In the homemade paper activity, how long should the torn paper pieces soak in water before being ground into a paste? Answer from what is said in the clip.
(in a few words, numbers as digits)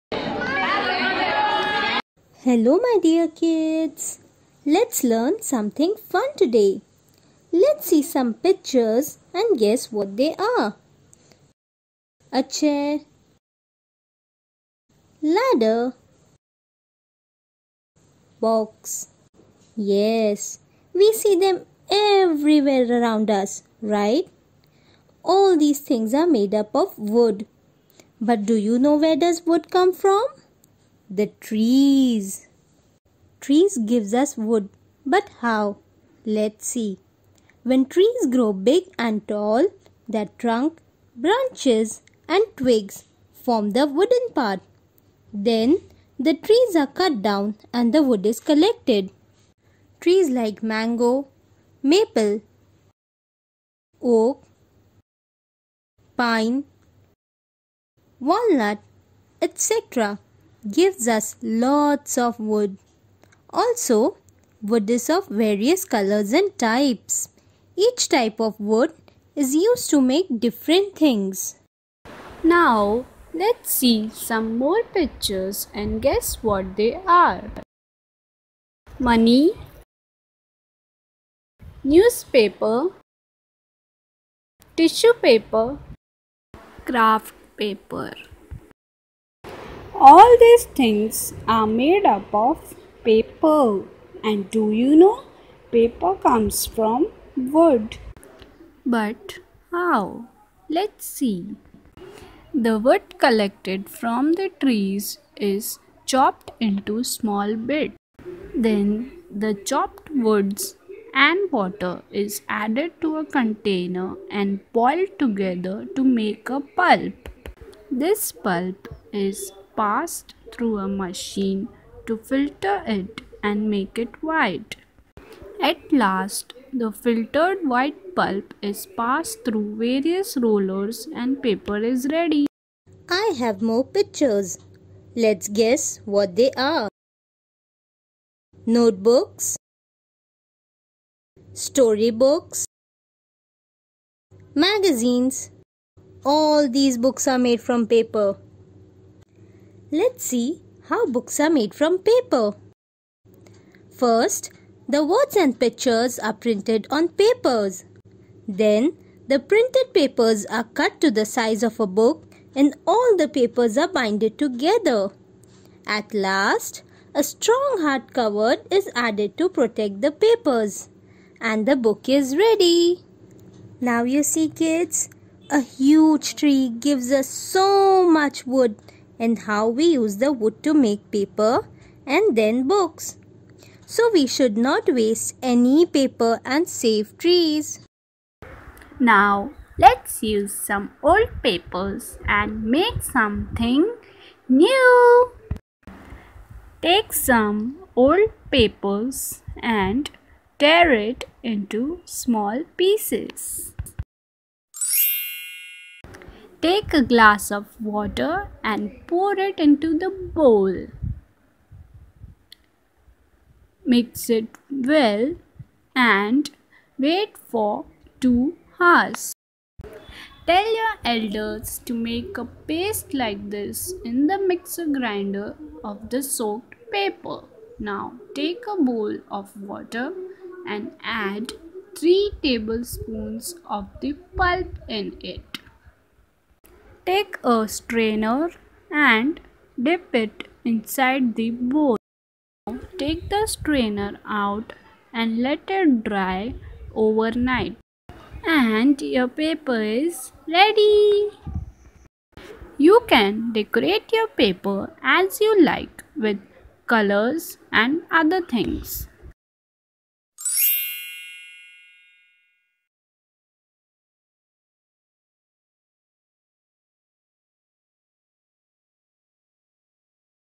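2 hours.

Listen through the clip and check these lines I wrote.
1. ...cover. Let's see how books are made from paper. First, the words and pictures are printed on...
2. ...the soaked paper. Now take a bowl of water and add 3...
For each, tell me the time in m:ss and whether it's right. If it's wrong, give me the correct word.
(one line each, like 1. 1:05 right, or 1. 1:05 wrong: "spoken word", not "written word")
1. 2:27 wrong: "paper", not "cover"
2. 3:46 right.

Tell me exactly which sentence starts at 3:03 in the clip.
So we should not waste any paper and save trees.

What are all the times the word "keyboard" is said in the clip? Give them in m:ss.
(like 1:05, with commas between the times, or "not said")
not said.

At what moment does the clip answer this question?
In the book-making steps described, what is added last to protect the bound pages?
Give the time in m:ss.
2:47.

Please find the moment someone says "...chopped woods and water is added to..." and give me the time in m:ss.
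1:49.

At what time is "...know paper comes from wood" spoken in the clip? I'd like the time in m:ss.
1:34.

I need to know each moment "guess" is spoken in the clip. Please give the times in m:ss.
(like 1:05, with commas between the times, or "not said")
0:09, 1:16, 2:15.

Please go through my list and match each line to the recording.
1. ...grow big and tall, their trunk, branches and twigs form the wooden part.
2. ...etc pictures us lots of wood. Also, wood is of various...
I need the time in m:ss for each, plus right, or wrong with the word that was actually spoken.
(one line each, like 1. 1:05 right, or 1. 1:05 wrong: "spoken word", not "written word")
1. 0:38 right
2. 0:59 wrong: "gives", not "pictures".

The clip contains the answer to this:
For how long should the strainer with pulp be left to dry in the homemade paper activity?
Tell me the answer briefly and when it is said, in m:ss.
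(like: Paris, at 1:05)
Overnight, at 4:06.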